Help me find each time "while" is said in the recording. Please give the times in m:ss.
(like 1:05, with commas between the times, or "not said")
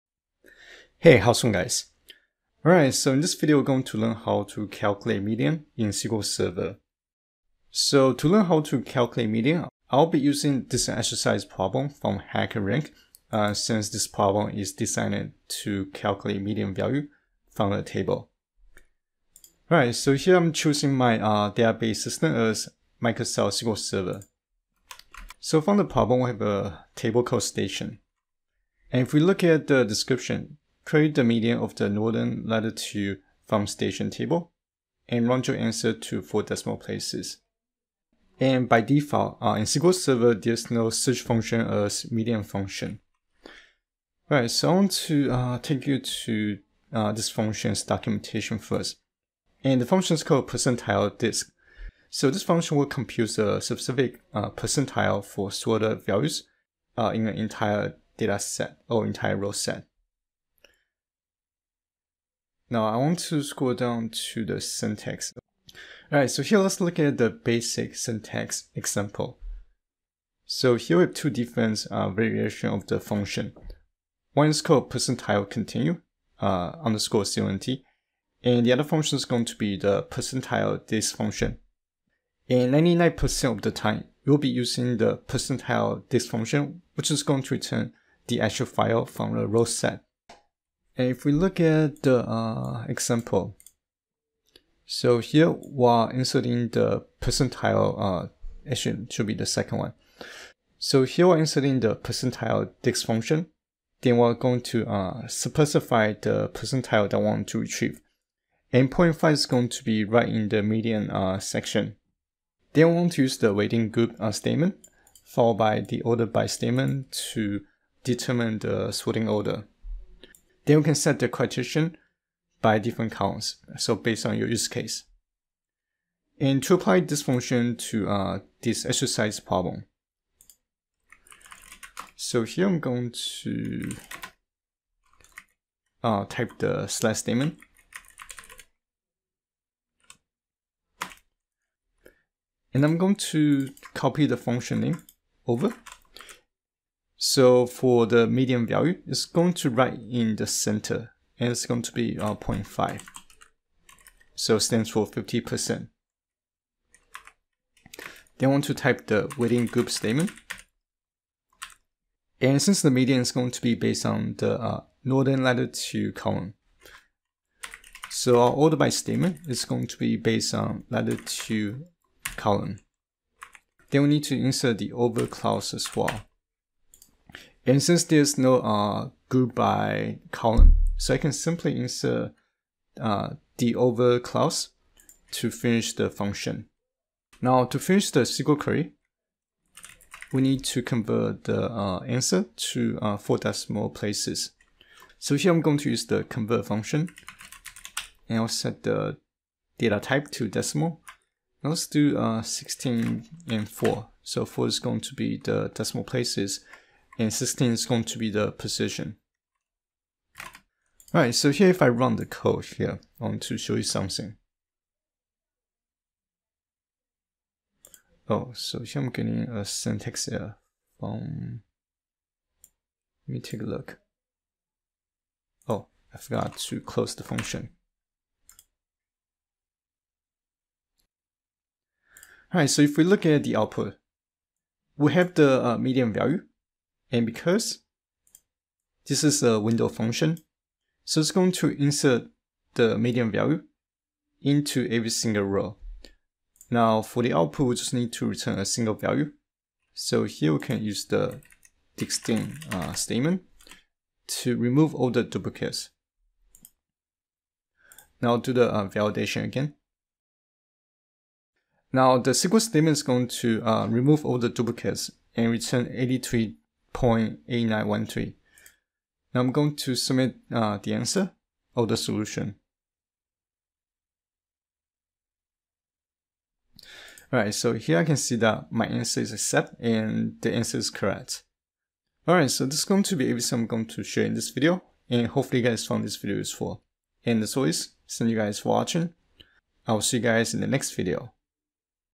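1:35.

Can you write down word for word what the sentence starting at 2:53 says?
Then we need to insert the over clause as well.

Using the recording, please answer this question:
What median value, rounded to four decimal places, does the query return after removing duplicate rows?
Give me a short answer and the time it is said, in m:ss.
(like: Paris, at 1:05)
83.8913, at 4:25.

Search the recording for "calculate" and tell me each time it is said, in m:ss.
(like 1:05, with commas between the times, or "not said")
0:04, 0:08, 0:15.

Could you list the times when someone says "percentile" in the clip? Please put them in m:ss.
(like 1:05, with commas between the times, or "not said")
0:50, 0:54, 1:14, 1:20, 1:25, 1:37, 1:41, 1:46.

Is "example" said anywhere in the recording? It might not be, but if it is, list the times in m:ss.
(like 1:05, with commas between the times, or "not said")
1:08, 1:32.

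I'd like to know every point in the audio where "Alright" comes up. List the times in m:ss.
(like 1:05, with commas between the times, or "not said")
0:02, 0:19, 1:06, 3:31, 3:52, 4:37, 4:42.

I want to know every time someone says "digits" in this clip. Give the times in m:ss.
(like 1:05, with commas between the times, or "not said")
not said.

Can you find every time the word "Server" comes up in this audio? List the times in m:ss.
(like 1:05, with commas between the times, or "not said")
0:06, 0:23, 0:39.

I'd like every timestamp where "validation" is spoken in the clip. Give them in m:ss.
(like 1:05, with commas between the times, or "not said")
4:18.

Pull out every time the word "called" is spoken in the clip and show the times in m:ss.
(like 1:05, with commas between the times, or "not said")
0:27, 0:50, 1:14.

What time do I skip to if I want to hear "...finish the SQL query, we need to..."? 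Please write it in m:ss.
3:07.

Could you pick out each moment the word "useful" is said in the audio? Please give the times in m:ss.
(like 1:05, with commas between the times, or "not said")
4:46.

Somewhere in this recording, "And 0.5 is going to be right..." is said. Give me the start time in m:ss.
1:48.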